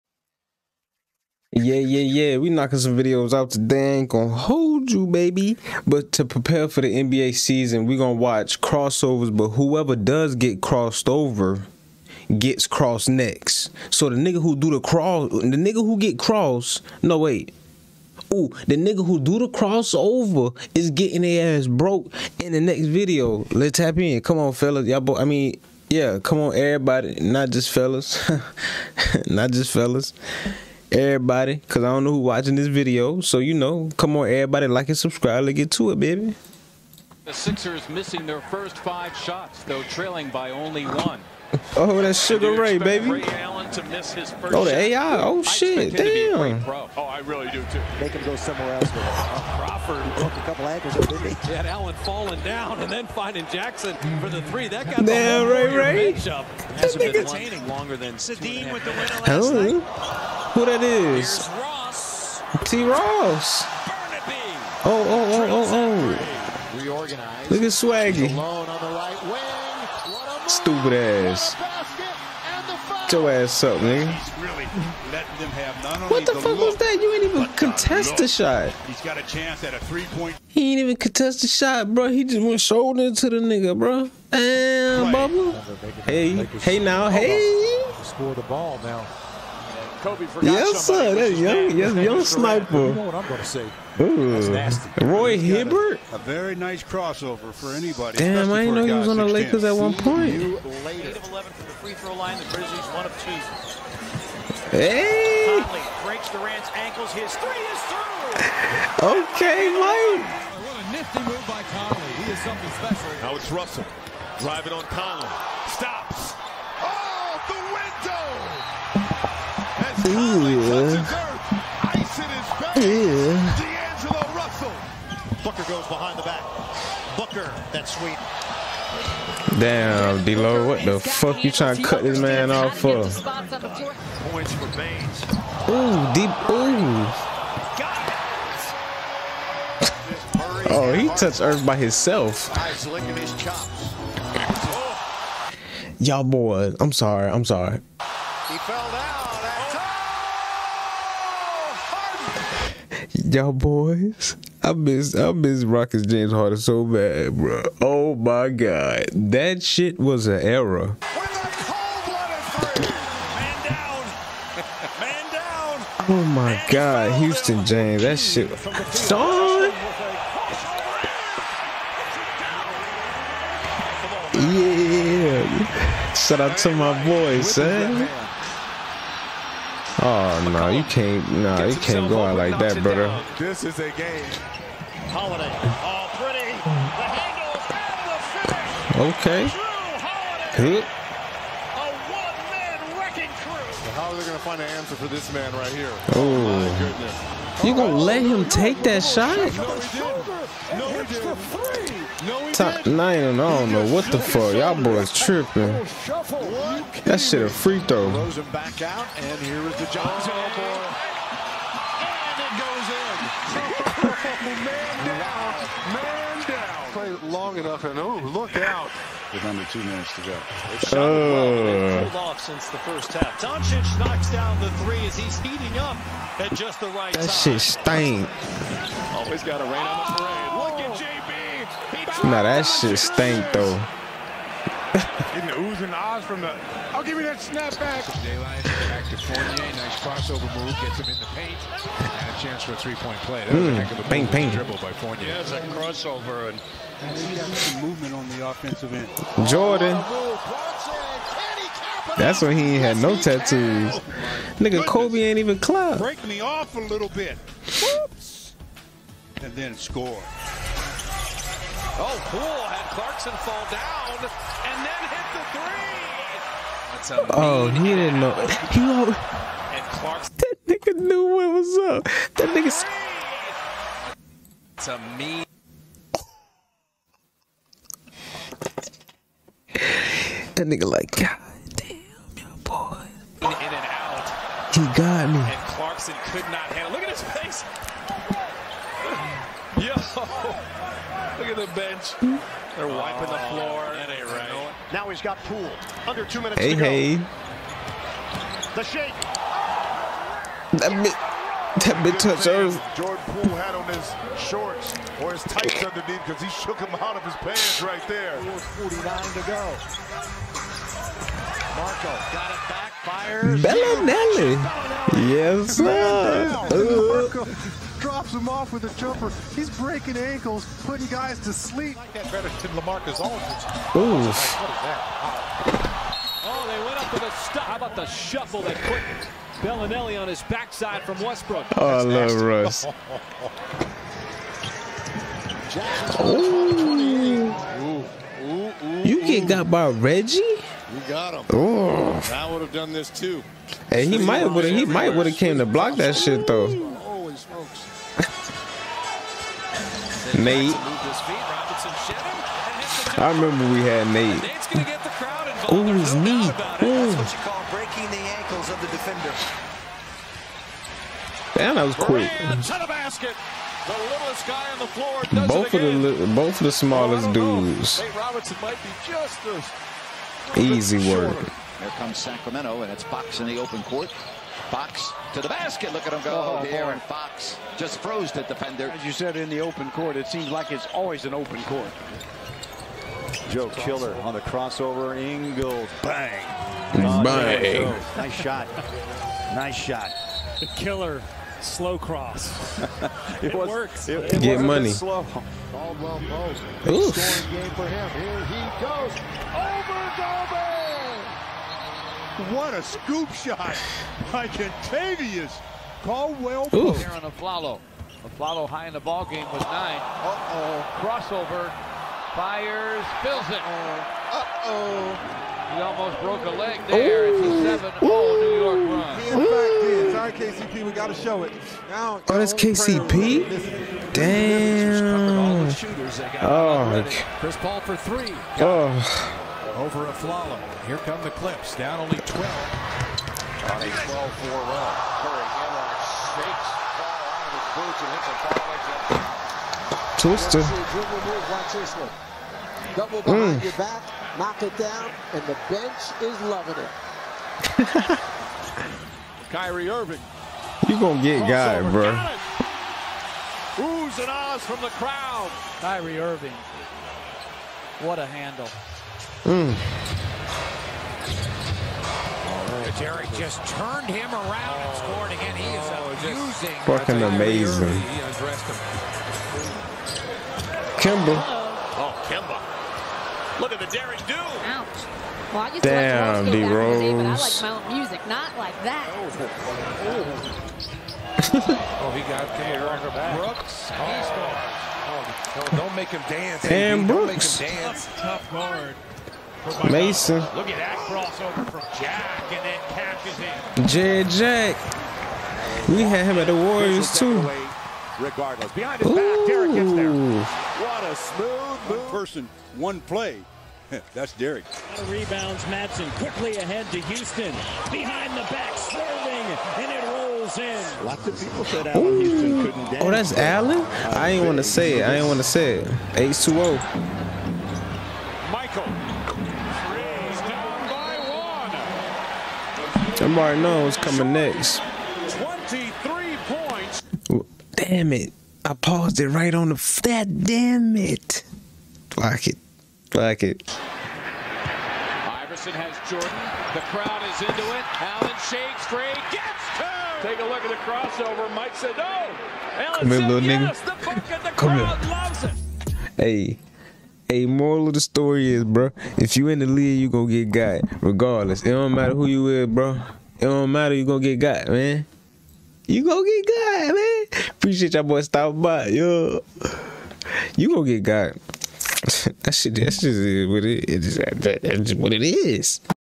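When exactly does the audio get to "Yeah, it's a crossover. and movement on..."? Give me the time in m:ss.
4:05.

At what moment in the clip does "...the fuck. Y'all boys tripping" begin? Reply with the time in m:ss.
3:24.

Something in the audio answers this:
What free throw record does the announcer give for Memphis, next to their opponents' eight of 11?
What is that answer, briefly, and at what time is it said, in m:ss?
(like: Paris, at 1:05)
1 of 2, at 1:42.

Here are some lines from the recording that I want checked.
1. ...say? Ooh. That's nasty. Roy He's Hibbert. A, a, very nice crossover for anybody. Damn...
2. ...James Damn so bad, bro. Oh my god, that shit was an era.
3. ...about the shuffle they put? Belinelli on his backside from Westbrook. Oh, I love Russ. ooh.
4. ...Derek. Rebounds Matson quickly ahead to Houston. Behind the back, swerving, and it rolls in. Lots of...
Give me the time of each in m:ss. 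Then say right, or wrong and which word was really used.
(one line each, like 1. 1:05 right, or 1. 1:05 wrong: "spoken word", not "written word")
1. 1:33 right
2. 2:36 wrong: "Harden", not "Damn"
3. 5:27 right
4. 8:24 right.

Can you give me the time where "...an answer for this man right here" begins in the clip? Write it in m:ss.
3:14.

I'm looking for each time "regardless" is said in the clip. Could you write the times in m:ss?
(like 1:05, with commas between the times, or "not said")
8:18, 9:11.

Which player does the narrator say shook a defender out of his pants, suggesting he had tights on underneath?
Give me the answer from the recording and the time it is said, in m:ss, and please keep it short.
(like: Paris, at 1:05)
Jordan Poole, at 5:02.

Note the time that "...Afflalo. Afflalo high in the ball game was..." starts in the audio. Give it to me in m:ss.
6:47.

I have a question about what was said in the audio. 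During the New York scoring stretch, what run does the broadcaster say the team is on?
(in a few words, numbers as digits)
7-0.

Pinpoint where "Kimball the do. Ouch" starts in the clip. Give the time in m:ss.
7:51.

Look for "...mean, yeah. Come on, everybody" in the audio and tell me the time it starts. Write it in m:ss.
0:25.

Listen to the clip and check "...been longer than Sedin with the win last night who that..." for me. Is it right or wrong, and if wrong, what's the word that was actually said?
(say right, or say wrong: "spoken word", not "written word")
right.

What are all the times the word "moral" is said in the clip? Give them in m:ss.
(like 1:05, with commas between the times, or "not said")
9:07.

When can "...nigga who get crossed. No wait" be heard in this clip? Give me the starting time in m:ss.
0:15.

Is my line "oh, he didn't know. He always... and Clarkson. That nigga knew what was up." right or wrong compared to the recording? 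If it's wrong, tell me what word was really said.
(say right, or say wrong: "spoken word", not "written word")
right.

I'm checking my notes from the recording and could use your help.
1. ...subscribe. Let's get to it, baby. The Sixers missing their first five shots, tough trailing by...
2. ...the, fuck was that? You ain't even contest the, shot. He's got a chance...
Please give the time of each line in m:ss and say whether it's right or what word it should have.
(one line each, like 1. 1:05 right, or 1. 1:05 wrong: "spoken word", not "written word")
1. 0:34 wrong: "though", not "tough"
2. 1:16 right.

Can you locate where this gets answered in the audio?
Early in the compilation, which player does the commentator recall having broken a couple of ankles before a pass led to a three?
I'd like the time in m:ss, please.
0:49.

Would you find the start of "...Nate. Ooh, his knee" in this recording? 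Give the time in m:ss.
5:54.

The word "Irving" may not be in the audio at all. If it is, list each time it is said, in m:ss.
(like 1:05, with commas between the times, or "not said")
7:29, 7:36.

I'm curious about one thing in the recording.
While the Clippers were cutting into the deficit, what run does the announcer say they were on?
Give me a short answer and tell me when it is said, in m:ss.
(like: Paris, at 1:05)
12-4, at 7:13.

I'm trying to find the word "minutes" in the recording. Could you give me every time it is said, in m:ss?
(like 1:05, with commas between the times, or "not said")
3:39, 4:56.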